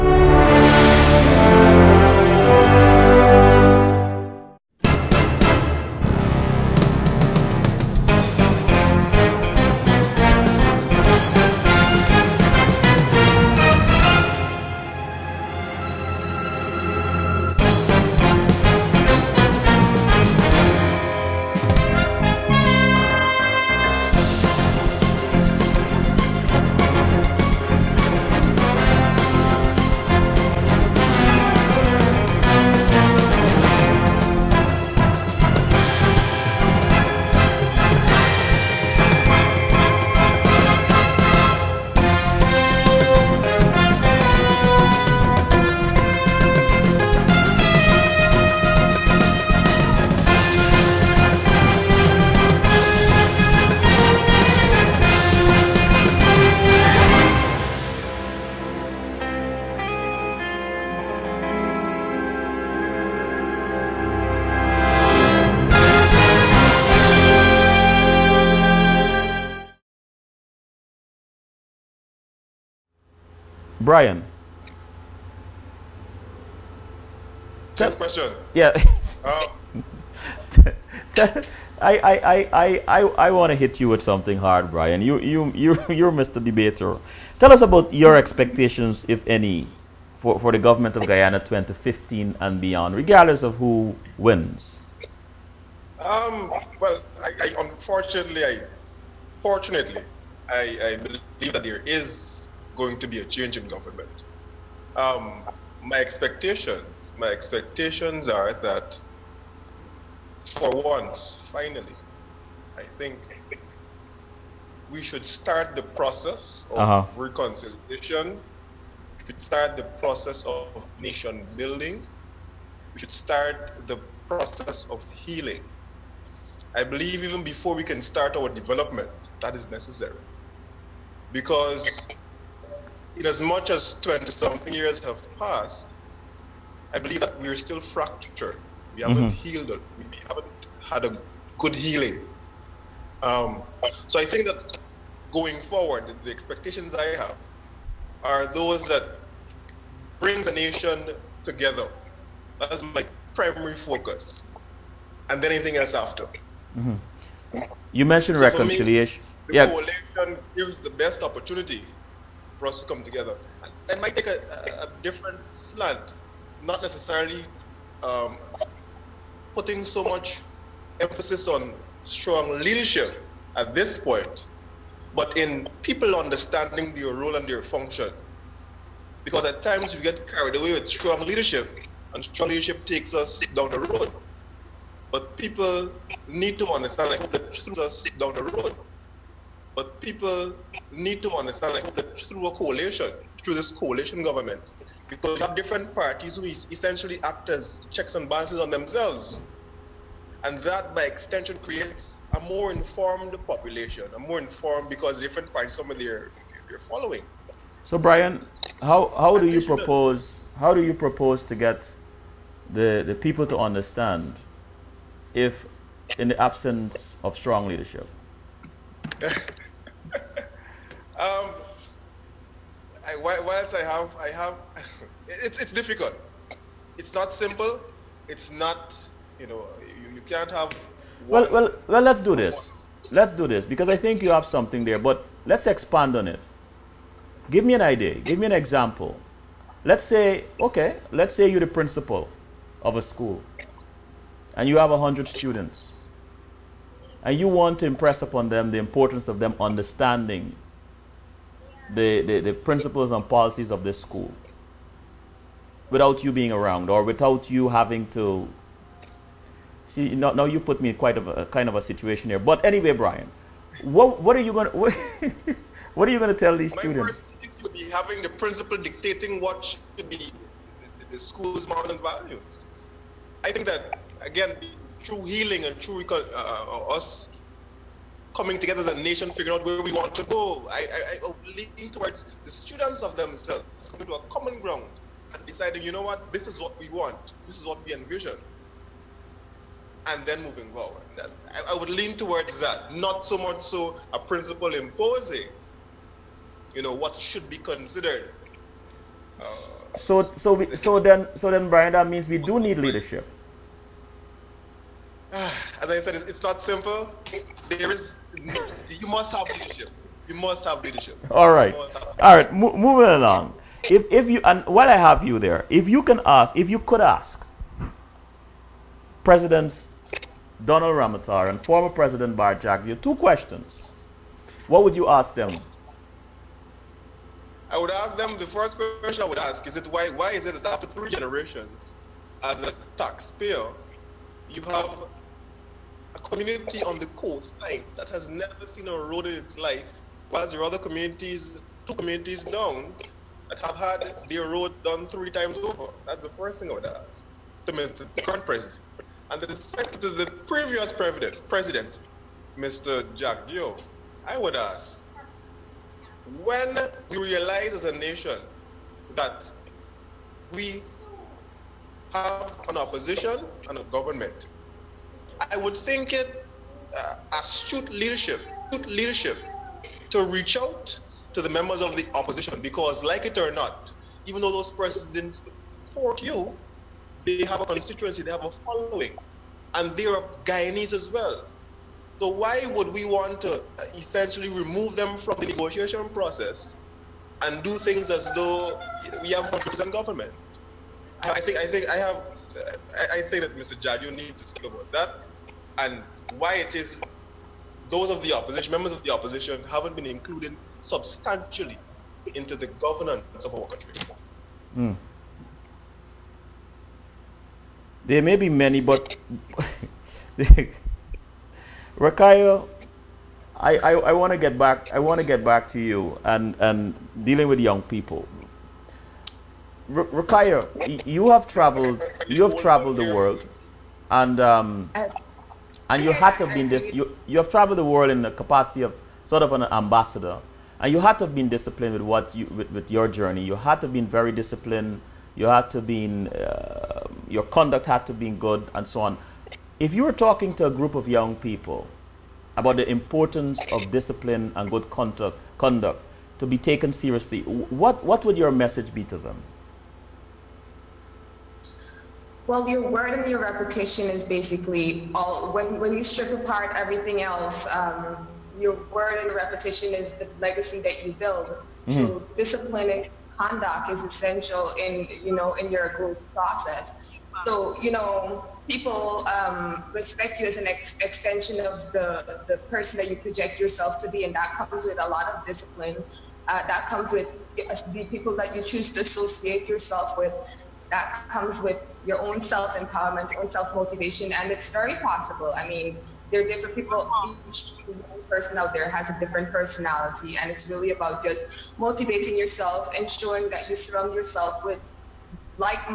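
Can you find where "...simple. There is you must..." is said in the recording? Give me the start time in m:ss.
5:06.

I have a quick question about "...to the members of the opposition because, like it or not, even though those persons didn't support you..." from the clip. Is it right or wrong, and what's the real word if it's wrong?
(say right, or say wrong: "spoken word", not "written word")
right.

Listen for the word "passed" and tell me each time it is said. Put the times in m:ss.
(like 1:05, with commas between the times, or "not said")
2:15.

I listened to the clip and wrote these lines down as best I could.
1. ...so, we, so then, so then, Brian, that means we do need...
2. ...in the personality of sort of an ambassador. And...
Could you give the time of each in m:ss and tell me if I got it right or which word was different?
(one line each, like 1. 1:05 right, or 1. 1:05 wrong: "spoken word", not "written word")
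1. 5:00 right
2. 7:08 wrong: "capacity", not "personality".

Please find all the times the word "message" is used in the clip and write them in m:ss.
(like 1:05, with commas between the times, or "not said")
7:28.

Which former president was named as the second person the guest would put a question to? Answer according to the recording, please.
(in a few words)
Bharrat Jagdeo.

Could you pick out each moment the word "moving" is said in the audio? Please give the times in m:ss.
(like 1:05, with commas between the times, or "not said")
4:50, 5:12.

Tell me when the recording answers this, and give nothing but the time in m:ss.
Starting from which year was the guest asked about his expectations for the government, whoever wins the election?
1:31.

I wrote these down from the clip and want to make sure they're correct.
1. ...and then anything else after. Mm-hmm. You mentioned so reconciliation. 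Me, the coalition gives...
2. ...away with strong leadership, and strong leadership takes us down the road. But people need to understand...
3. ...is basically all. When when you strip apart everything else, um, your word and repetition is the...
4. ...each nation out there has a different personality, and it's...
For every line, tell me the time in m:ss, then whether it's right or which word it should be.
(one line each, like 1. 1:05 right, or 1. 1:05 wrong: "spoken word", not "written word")
1. 2:35 right
2. 3:00 right
3. 7:34 right
4. 8:07 wrong: "person", not "nation".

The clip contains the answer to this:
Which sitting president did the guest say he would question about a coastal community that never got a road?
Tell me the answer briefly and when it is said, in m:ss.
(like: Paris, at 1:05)
Donald Ramotar, at 5:20.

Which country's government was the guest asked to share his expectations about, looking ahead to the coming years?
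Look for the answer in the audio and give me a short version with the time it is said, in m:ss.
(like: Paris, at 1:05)
Guyana, at 1:31.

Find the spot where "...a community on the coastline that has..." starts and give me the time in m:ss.
5:36.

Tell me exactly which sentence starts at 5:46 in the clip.
That's the first thing I would ask to Mr.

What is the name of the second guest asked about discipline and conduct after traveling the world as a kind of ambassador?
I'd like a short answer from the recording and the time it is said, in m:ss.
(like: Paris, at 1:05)
Rakayo, at 6:51.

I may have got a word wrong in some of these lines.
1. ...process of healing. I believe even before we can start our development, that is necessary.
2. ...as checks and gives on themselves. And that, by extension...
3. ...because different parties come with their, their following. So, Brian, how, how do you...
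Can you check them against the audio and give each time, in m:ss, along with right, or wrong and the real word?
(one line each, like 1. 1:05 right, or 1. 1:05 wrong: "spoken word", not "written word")
1. 2:04 right
2. 3:17 wrong: "balances", not "gives"
3. 3:24 right.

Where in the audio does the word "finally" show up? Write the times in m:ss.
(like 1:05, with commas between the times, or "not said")
1:51.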